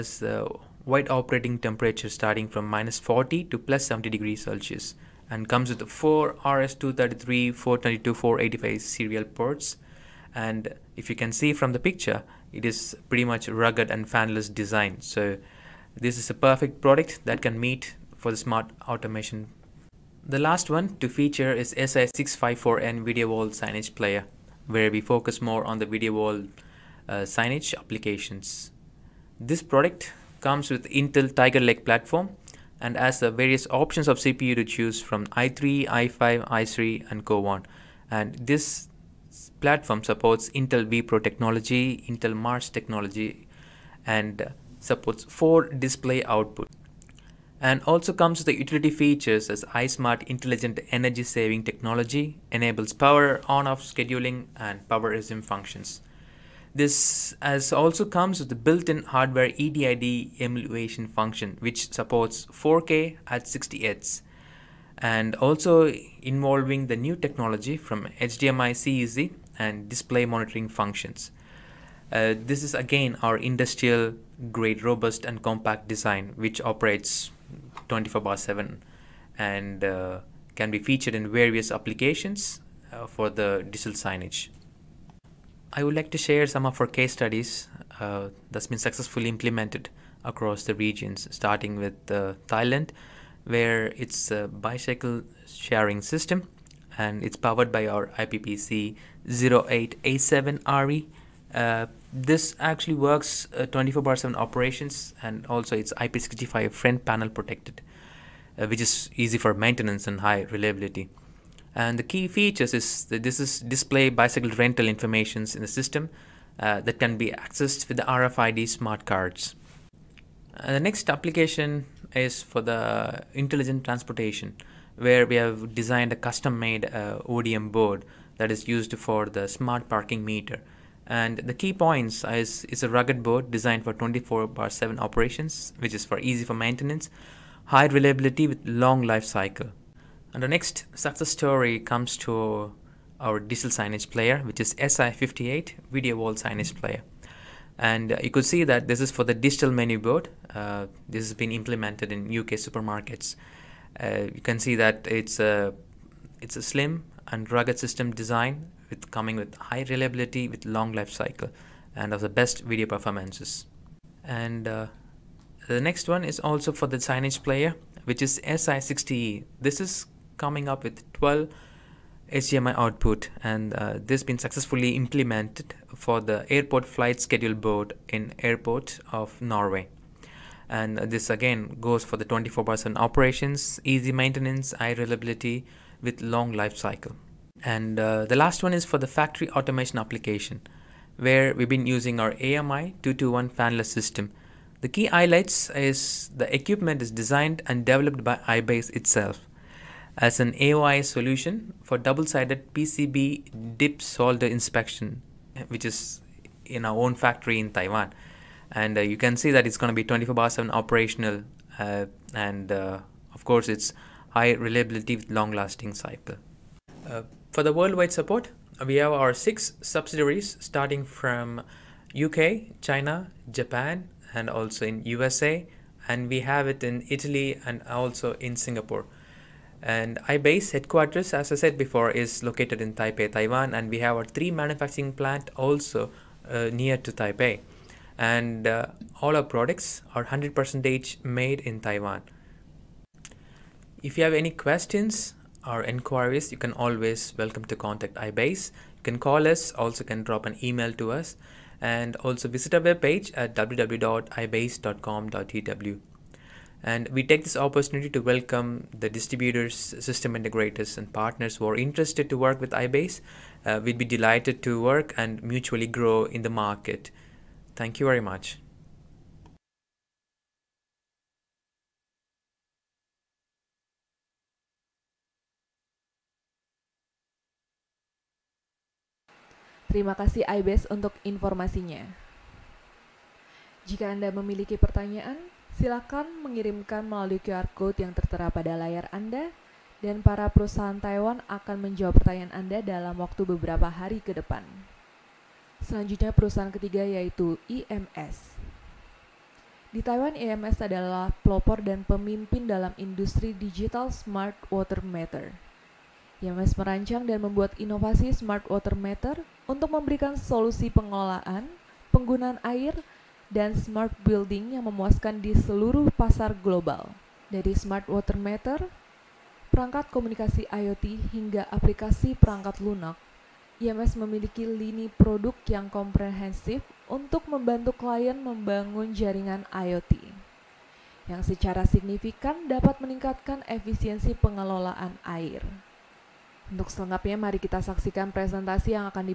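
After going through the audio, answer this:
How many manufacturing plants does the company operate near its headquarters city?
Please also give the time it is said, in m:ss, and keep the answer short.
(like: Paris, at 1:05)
3, at 3:54.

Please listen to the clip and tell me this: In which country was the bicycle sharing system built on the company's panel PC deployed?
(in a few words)
Thailand.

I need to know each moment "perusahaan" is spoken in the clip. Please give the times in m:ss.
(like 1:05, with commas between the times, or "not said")
4:50, 4:56.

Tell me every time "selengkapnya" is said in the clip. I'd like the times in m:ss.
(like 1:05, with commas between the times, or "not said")
5:36.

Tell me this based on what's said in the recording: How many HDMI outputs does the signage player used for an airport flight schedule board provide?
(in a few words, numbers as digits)
12.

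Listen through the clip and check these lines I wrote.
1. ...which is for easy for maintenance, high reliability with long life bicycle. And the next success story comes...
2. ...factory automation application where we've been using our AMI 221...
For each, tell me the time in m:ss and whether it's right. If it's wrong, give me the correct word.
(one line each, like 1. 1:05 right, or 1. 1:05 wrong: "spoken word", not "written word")
1. 2:15 wrong: "cycle", not "bicycle"
2. 3:09 right.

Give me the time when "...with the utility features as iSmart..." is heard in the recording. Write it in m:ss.
0:48.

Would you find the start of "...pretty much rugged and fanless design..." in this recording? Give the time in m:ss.
0:13.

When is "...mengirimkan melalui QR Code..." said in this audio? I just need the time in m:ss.
4:46.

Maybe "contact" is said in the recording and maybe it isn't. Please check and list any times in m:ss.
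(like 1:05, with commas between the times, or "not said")
4:07.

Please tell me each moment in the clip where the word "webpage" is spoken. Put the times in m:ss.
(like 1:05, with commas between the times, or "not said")
4:12.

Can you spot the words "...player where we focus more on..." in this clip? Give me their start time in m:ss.
0:23.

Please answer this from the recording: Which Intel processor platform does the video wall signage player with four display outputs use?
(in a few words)
Tiger Lake.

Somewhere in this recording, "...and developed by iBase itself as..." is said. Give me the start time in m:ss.
3:17.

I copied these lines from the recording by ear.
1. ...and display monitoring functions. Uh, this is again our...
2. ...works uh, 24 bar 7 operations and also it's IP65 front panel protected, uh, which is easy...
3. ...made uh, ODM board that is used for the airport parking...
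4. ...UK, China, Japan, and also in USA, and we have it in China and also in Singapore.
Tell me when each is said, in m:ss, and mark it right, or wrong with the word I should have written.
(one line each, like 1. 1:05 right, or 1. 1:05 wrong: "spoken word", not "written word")
1. 1:09 right
2. 1:42 right
3. 2:06 wrong: "smart", not "airport"
4. 3:42 wrong: "Italy", not "China".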